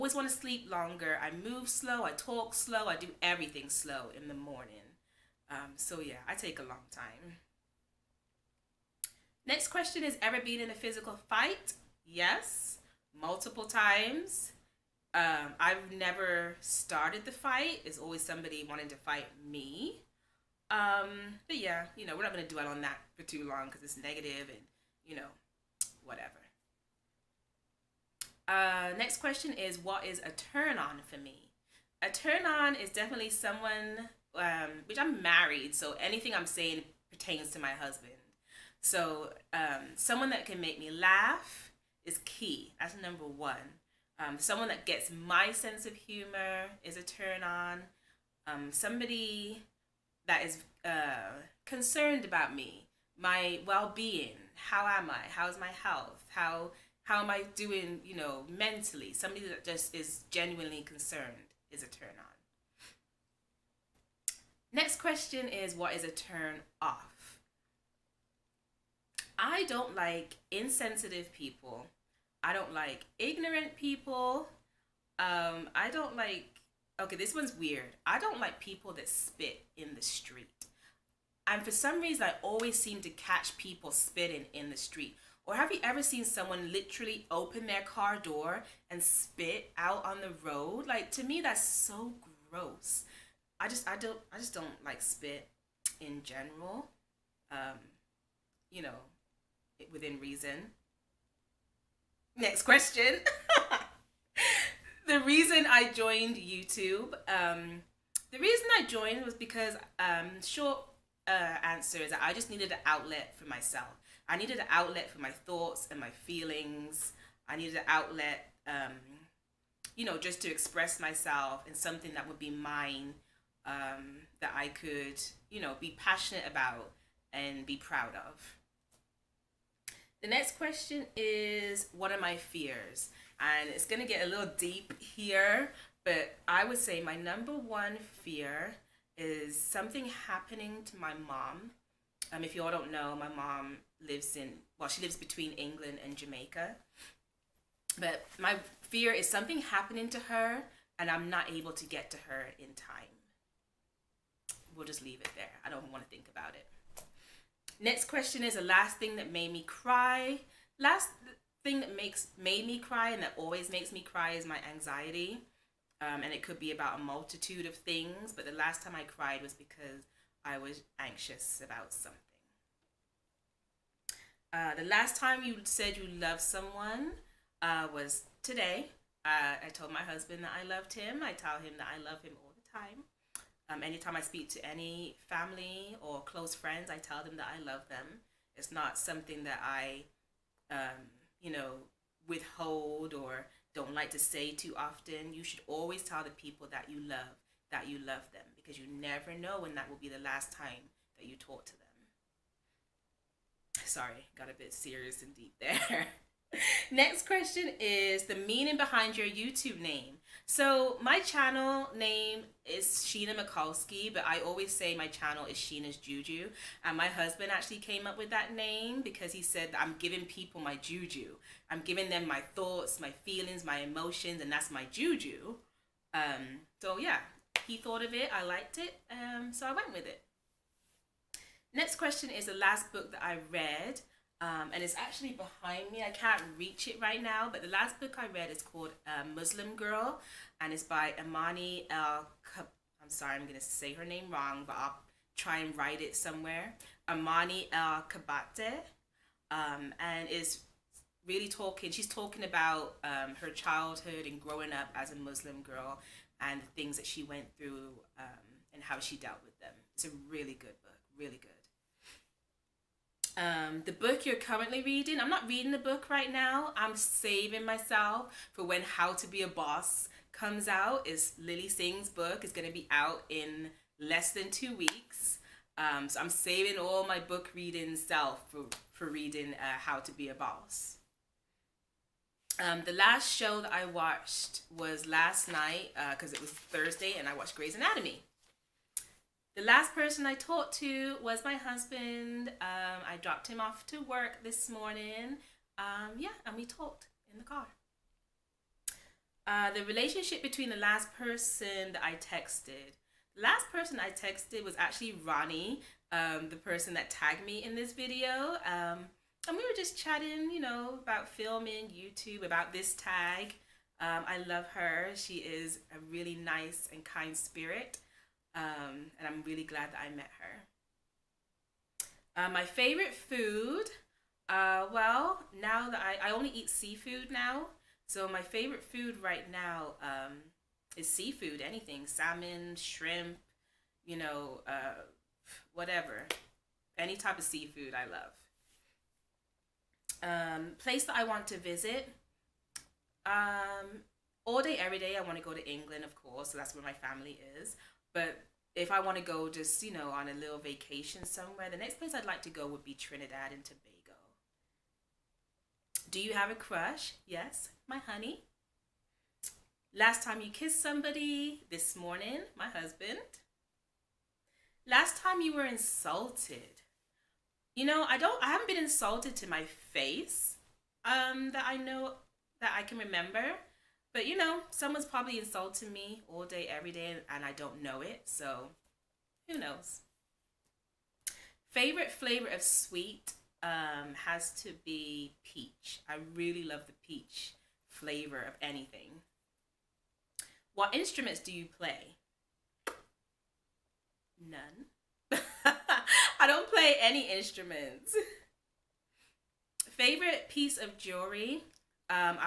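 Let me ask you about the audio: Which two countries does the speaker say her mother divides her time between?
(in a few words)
England and Jamaica.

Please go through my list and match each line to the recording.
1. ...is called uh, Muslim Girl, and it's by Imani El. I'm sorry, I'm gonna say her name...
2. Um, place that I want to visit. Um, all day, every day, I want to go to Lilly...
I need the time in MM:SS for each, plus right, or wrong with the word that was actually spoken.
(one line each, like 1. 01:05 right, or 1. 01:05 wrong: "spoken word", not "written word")
1. 03:58 right
2. 05:40 wrong: "England", not "Lilly".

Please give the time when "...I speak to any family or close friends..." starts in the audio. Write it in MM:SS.
03:04.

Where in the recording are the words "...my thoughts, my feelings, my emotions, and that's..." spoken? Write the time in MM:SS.
03:42.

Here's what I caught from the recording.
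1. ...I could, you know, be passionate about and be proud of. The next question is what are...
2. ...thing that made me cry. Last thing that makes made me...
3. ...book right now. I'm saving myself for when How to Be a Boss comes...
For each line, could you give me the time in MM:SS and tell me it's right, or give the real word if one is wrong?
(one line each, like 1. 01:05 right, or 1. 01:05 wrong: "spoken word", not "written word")
1. 02:04 right
2. 02:38 right
3. 04:25 right.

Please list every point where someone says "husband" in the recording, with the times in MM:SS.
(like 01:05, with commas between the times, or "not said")
00:37, 03:00, 03:37, 04:51, 06:02.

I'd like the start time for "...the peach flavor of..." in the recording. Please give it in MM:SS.
06:26.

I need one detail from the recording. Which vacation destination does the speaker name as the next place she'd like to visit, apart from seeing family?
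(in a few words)
Trinidad and Tobago.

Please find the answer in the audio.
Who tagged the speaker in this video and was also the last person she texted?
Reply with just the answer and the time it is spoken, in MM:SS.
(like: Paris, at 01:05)
Ronnie, at 05:05.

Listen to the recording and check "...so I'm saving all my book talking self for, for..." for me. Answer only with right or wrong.
wrong.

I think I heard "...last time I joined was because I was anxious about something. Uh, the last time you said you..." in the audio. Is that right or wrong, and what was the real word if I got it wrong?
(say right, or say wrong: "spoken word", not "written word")
wrong: "cried", not "joined".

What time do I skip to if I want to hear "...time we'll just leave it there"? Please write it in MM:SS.
02:32.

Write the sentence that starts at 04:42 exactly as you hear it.
Um, the last show that I watched was last night because uh, it was Thursday and I watched Grey's Anatomy.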